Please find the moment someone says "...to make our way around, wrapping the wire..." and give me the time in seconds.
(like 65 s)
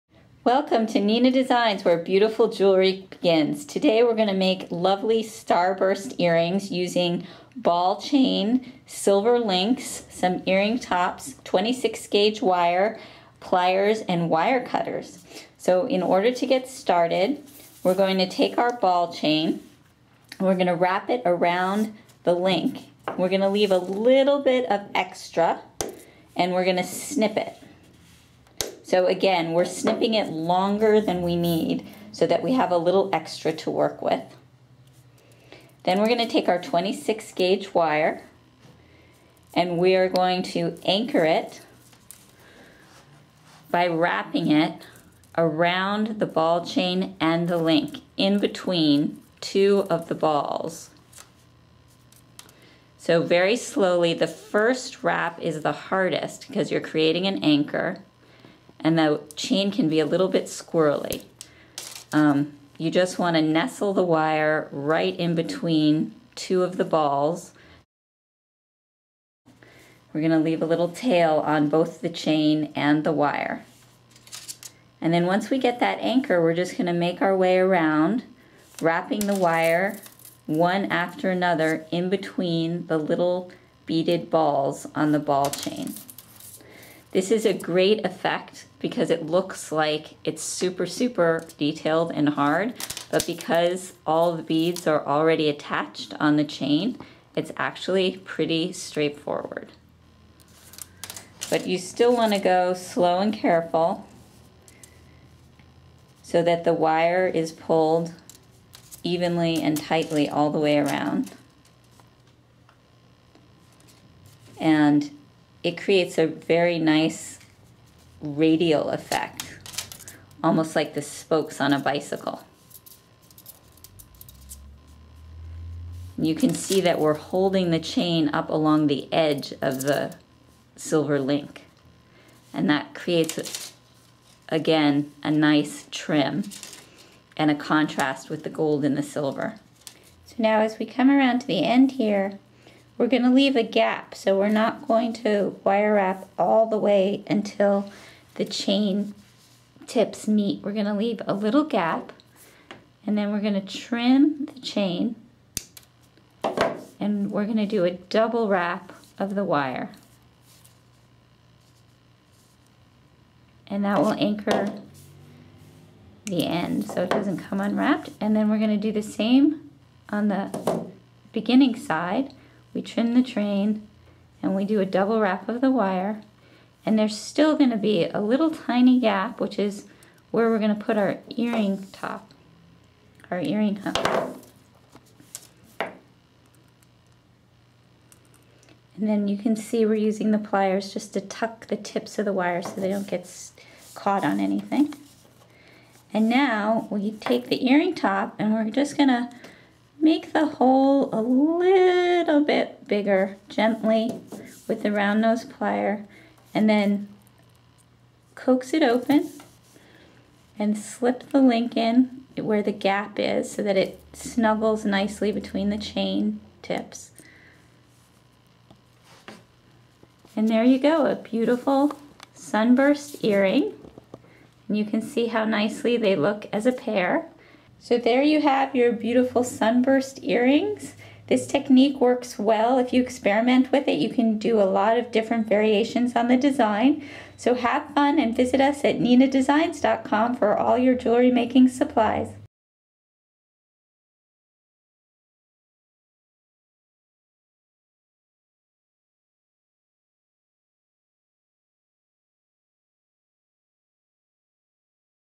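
76 s.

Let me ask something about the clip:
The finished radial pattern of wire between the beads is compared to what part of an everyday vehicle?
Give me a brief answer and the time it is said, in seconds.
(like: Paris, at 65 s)
Spokes on a bicycle, at 121 s.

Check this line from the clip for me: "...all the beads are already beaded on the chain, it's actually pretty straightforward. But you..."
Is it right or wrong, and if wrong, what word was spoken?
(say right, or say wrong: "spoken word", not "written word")
wrong: "attached", not "beaded".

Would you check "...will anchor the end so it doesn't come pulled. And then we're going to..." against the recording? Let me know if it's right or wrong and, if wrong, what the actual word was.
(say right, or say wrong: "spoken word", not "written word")
wrong: "unwrapped", not "pulled".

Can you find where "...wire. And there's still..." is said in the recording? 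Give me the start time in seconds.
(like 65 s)
175 s.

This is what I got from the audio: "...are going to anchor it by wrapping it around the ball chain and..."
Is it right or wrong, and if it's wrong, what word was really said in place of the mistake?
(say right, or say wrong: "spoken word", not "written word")
right.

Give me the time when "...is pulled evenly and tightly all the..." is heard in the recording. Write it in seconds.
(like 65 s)
107 s.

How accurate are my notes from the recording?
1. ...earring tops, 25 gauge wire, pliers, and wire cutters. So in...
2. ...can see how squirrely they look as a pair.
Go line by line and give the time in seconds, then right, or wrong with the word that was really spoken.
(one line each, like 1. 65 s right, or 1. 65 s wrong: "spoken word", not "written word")
1. 10 s wrong: "26", not "25"
2. 224 s wrong: "nicely", not "squirrely".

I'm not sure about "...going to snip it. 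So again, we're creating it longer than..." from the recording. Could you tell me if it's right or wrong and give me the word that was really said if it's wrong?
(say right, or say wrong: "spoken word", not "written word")
wrong: "snipping", not "creating".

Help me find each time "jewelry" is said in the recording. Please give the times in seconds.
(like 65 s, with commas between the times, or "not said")
2 s, 240 s.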